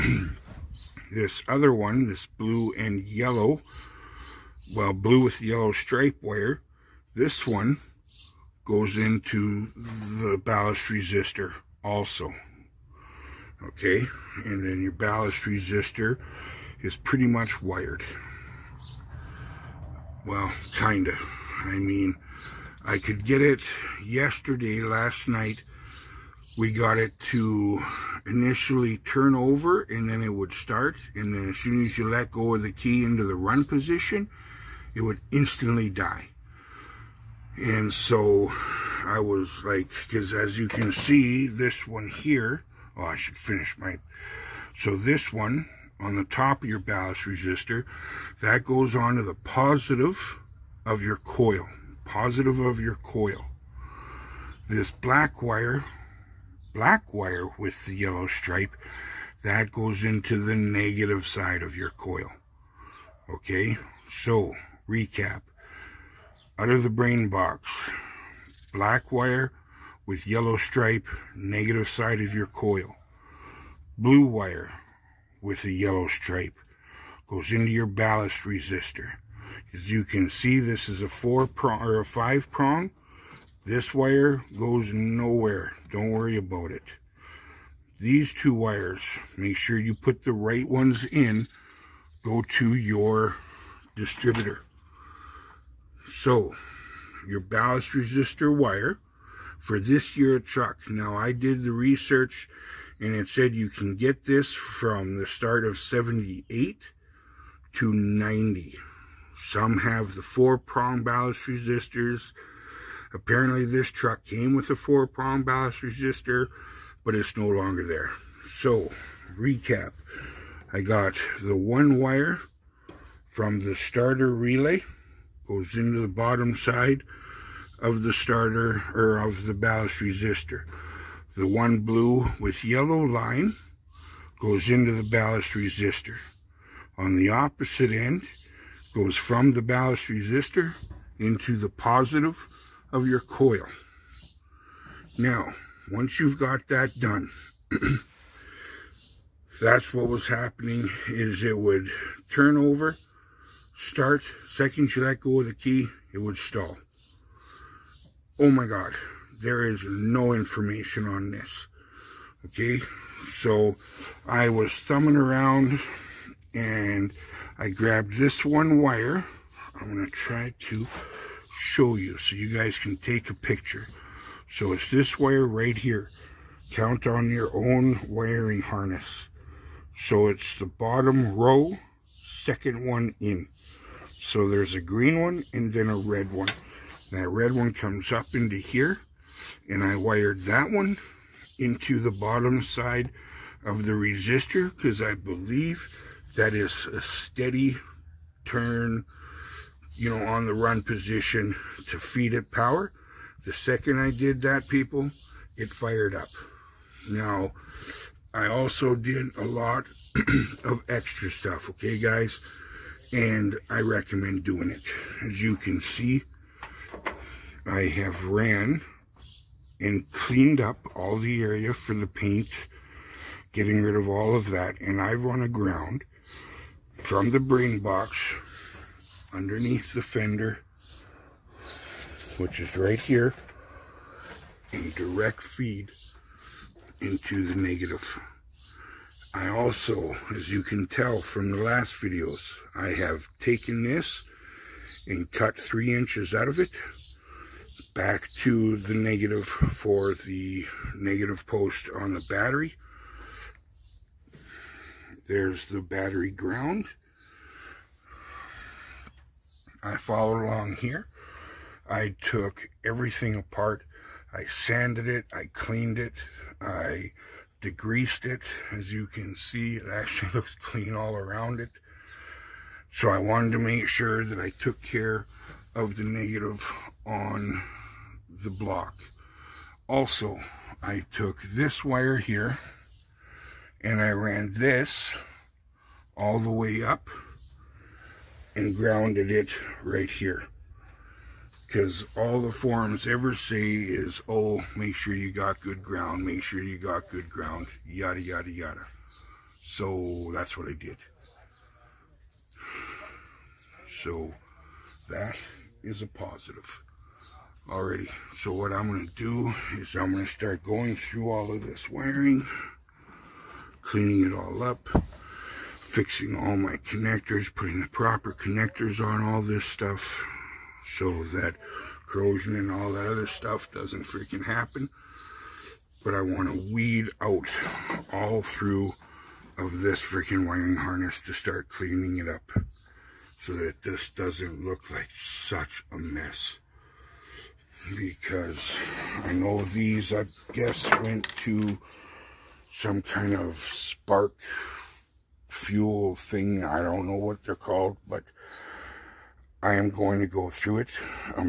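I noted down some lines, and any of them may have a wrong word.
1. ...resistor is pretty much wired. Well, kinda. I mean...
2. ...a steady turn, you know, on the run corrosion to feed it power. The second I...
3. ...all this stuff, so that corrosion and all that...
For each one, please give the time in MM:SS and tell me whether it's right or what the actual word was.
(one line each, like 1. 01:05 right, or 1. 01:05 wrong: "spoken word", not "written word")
1. 00:15 right
2. 03:16 wrong: "position", not "corrosion"
3. 05:19 right.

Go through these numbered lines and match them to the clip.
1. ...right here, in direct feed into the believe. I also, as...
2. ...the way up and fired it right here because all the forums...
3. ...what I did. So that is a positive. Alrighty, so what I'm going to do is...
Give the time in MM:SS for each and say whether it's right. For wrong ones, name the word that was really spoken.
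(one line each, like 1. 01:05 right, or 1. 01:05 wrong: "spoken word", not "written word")
1. 03:52 wrong: "negative", not "believe"
2. 04:46 wrong: "grounded", not "fired"
3. 05:00 right.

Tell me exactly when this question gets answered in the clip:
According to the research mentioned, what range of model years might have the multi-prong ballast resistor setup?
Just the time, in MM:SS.
01:45.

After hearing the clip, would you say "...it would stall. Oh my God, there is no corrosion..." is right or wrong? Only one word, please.
wrong.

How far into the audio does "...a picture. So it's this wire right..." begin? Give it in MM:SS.
02:53.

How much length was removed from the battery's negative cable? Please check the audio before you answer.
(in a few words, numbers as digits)
3 inches.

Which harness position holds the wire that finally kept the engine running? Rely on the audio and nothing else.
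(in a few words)
Bottom row second one.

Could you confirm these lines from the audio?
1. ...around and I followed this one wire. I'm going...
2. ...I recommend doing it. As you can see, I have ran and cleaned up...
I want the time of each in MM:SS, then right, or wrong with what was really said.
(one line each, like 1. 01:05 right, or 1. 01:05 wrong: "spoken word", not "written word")
1. 02:45 wrong: "grabbed", not "followed"
2. 03:33 right.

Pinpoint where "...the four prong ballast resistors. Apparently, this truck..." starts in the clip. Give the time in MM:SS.
01:50.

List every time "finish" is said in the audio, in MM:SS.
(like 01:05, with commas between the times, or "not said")
00:43.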